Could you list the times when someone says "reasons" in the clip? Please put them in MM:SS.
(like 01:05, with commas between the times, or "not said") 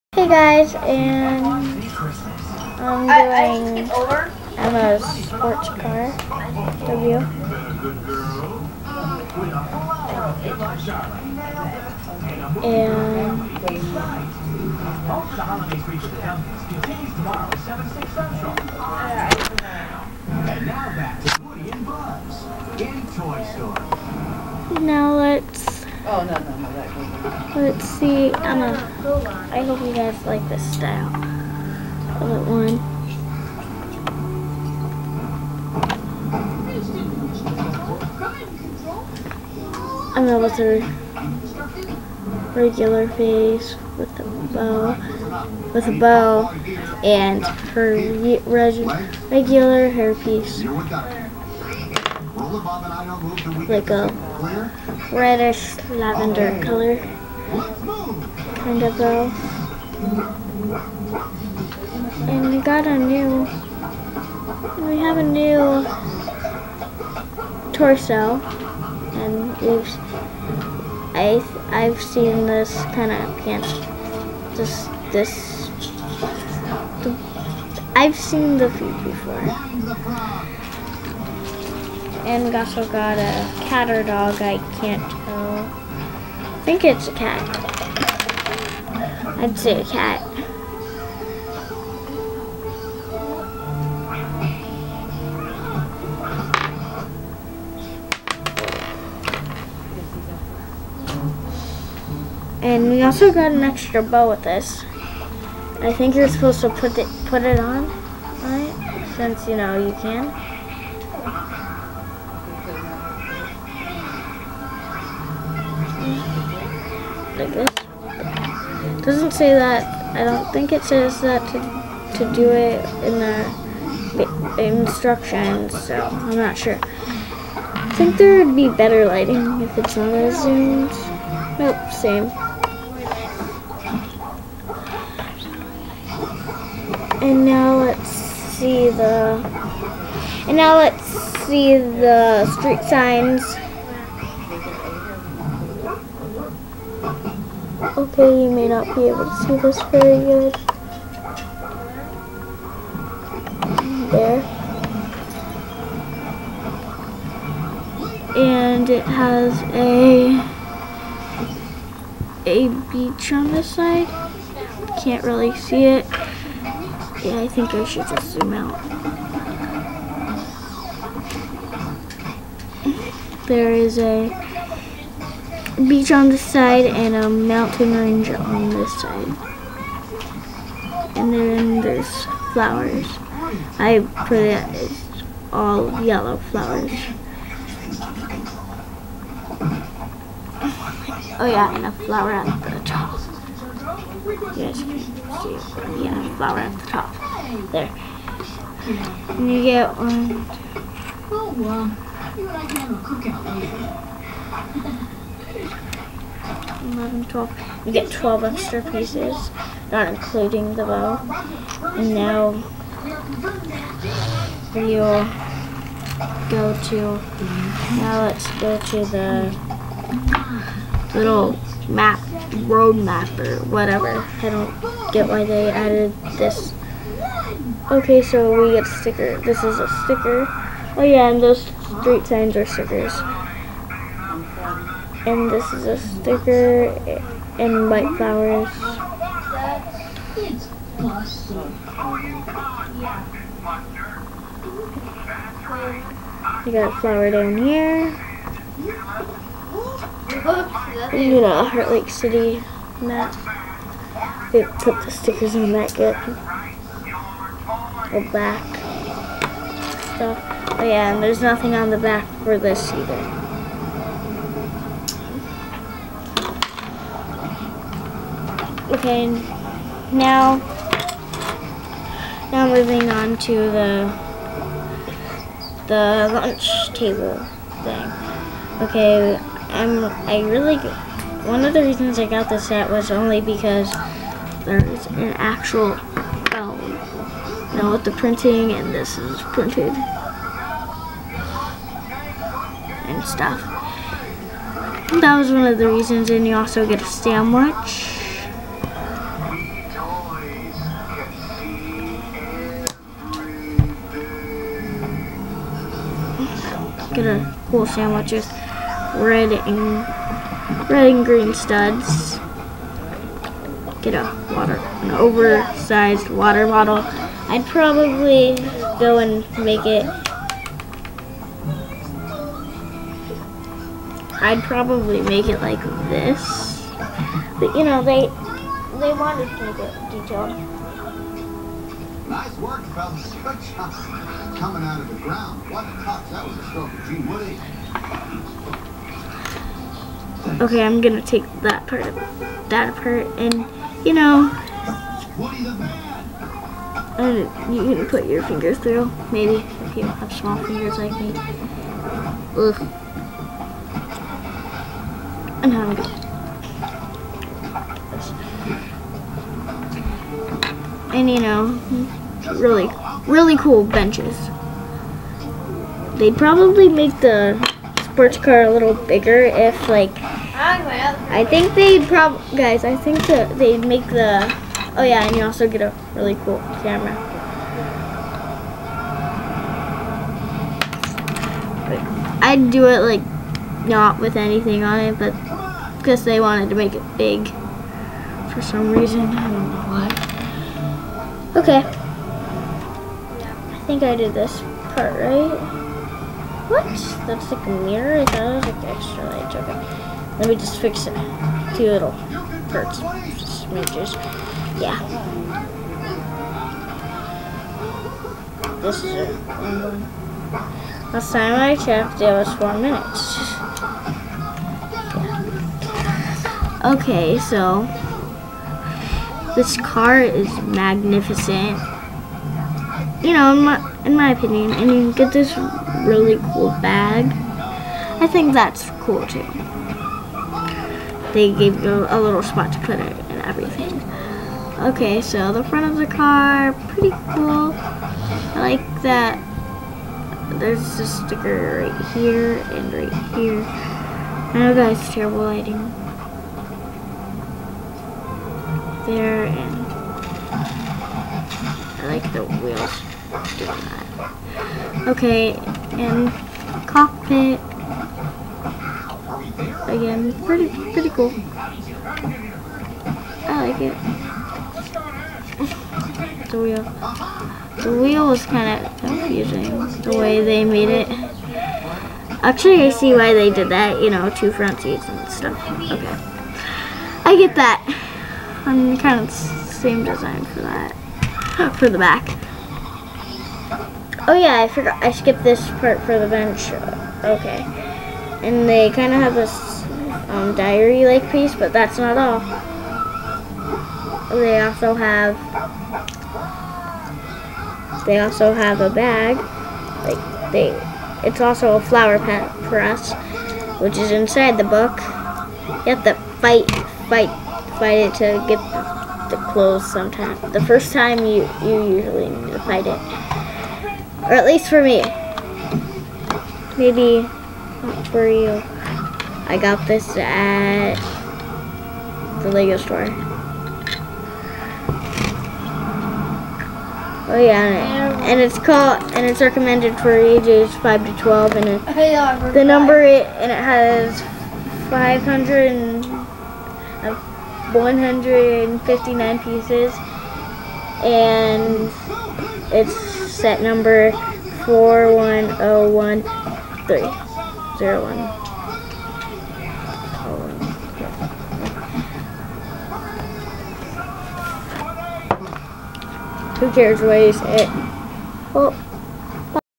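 04:41, 04:55, 06:28.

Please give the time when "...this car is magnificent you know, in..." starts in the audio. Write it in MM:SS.
06:59.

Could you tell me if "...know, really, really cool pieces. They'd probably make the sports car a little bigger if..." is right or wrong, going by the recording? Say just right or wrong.
wrong.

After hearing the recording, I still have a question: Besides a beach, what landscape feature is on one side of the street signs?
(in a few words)
Mountain range.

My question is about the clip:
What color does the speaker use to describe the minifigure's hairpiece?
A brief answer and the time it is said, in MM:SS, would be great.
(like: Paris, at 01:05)
Reddish lavender, at 00:55.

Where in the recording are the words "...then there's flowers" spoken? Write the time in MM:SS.
03:01.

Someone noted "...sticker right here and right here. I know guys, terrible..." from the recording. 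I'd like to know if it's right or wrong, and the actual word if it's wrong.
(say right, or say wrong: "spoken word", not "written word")
right.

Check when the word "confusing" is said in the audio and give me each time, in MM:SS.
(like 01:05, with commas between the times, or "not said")
07:48.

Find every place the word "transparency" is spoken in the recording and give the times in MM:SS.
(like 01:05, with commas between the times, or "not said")
not said.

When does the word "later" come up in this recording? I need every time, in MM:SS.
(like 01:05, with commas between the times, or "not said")
03:25.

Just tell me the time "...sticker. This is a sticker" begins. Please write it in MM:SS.
03:48.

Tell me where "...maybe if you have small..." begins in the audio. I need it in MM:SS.
05:49.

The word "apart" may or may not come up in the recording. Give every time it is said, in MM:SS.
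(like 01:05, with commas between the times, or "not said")
05:42.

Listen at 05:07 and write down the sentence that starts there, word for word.
Get a cool sandwich with red and red and green studs.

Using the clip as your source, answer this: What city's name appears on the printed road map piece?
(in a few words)
Heartlake City.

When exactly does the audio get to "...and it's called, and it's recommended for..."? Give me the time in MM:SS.
08:48.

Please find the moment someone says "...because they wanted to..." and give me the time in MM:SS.
06:25.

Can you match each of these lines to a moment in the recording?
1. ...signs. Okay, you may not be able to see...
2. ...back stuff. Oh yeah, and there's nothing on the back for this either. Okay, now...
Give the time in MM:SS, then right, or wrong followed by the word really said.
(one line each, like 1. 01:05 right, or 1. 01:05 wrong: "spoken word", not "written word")
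1. 02:22 right
2. 04:18 right.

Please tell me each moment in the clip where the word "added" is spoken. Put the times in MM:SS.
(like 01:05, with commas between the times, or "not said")
03:45.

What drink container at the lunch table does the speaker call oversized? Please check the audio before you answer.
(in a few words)
Water bottle.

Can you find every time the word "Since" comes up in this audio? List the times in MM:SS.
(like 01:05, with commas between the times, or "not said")
01:49.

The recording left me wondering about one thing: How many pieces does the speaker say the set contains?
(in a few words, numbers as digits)
559.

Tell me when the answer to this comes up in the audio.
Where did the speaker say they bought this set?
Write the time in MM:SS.
08:42.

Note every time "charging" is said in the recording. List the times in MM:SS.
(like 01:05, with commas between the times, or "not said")
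not said.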